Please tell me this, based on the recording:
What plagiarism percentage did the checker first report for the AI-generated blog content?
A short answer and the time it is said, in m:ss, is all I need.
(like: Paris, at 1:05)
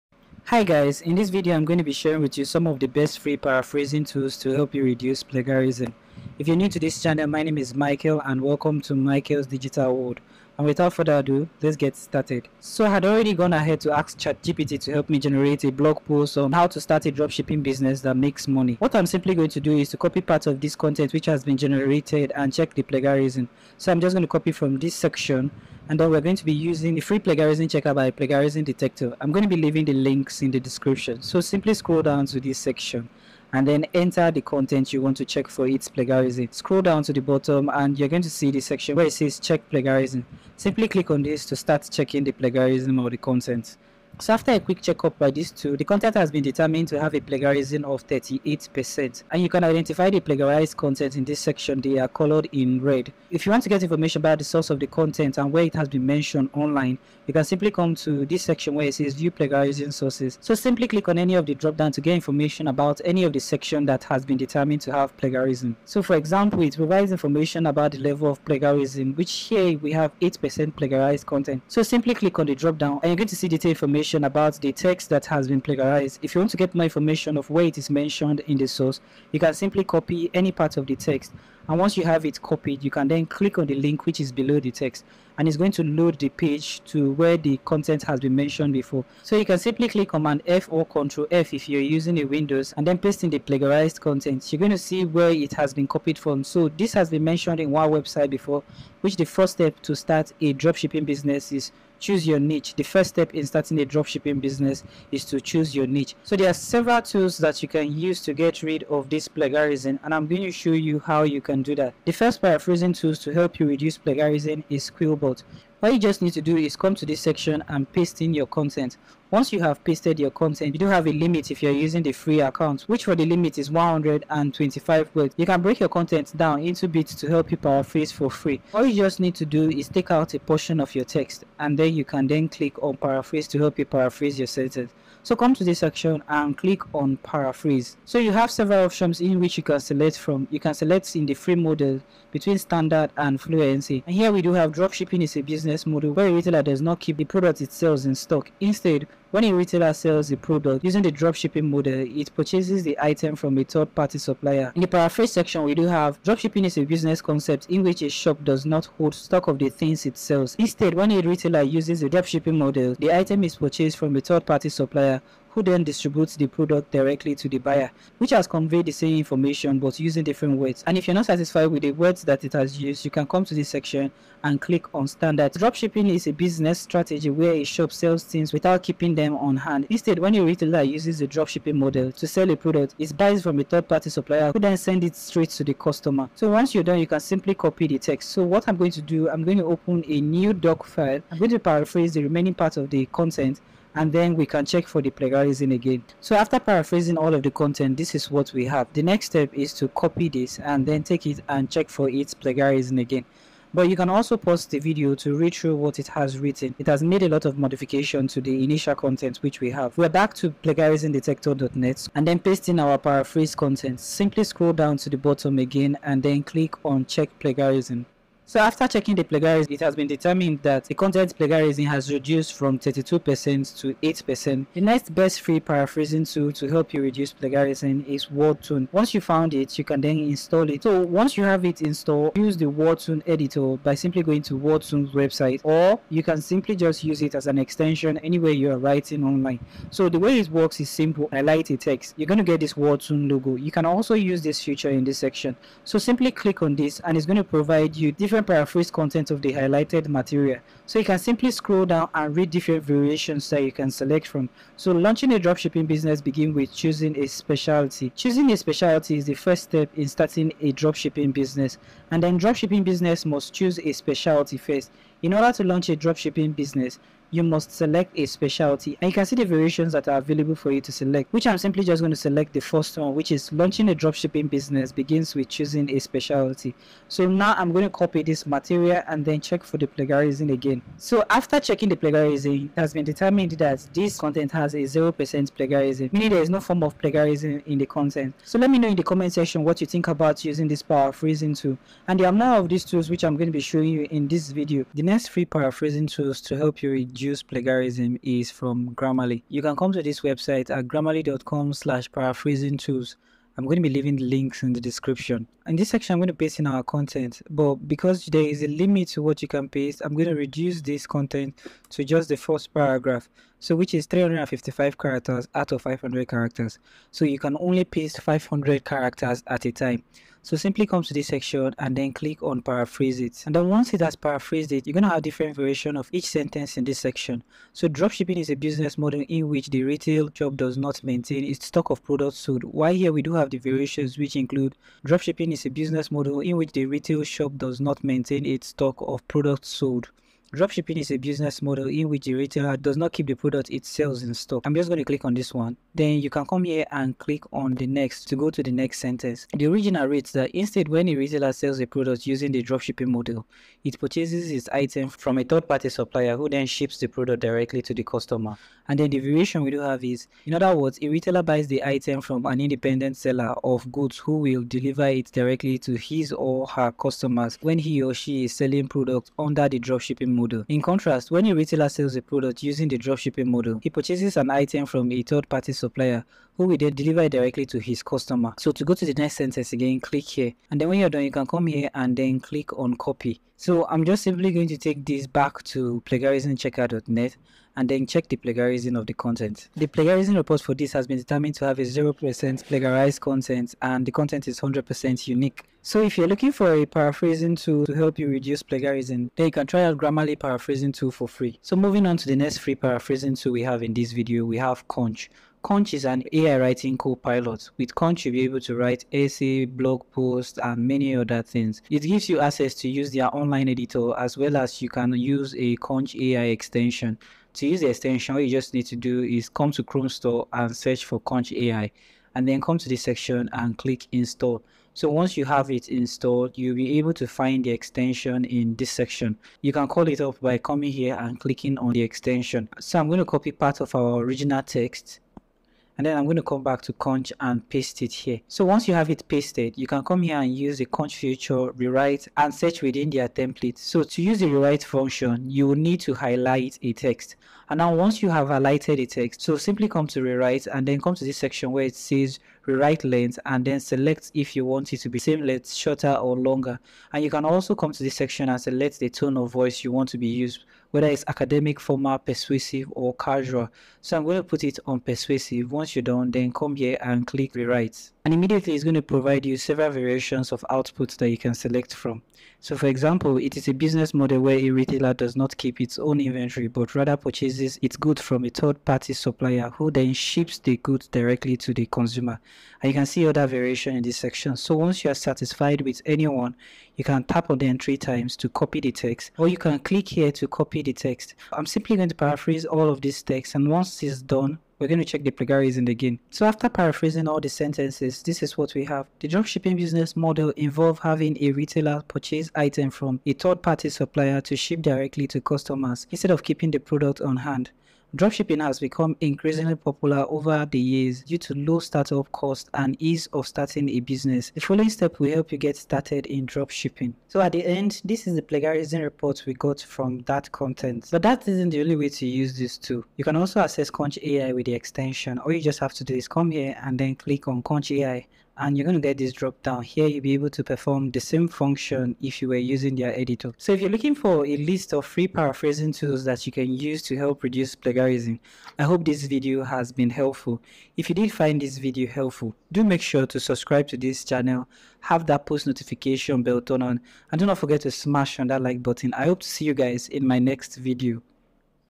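38%, at 0:48.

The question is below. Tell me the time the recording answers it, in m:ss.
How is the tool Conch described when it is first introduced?
6:46.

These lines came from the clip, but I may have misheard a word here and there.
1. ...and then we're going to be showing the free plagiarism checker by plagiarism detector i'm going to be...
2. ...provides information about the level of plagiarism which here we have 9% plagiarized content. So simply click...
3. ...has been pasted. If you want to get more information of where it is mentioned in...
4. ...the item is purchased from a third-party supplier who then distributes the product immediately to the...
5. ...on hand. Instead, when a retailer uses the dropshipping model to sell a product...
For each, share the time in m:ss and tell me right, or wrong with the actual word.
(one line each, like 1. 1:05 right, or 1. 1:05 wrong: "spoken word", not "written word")
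1. 0:25 wrong: "using", not "showing"
2. 1:06 wrong: "8", not "9"
3. 1:15 wrong: "plagiarized", not "pasted"
4. 2:42 wrong: "directly", not "immediately"
5. 2:59 right.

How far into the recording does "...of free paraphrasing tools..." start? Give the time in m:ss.
8:54.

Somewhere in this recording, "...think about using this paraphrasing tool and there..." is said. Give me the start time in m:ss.
4:49.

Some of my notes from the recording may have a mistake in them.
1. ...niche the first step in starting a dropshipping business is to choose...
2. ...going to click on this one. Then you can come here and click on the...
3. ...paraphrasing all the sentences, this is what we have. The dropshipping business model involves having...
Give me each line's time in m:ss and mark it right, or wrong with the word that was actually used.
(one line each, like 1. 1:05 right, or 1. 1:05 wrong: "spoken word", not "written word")
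1. 1:42 right
2. 5:44 right
3. 8:16 right.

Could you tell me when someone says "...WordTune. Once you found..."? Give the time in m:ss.
3:48.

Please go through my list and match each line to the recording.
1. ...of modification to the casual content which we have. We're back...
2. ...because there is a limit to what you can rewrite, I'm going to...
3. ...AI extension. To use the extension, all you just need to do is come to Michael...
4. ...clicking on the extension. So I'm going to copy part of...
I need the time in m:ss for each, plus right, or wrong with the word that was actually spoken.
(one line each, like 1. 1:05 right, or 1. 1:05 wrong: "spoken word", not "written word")
1. 3:27 wrong: "initial", not "casual"
2. 5:07 wrong: "paste", not "rewrite"
3. 6:56 wrong: "Chrome", not "Michael"
4. 7:11 right.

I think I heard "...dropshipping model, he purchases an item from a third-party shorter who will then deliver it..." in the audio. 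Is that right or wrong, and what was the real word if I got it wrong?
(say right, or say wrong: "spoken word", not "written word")
wrong: "supplier", not "shorter".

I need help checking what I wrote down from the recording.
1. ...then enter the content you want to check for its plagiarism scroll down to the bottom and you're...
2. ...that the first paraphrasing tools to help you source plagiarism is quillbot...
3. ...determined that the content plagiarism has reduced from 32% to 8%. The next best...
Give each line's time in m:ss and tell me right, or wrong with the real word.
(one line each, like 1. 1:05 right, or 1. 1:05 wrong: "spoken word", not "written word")
1. 0:33 right
2. 1:51 wrong: "reduce", not "source"
3. 3:40 right.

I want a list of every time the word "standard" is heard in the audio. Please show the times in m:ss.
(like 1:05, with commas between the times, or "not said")
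2:22, 2:55.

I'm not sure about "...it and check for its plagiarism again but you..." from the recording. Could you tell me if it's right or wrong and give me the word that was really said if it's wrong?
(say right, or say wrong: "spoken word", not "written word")
right.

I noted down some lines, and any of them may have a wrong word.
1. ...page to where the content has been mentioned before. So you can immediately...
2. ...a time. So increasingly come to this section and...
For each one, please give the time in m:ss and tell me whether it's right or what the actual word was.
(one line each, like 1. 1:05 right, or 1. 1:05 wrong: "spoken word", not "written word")
1. 1:26 wrong: "simply", not "immediately"
2. 5:19 wrong: "simply", not "increasingly".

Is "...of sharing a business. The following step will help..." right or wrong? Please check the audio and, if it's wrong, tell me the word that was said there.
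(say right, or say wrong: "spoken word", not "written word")
wrong: "starting", not "sharing".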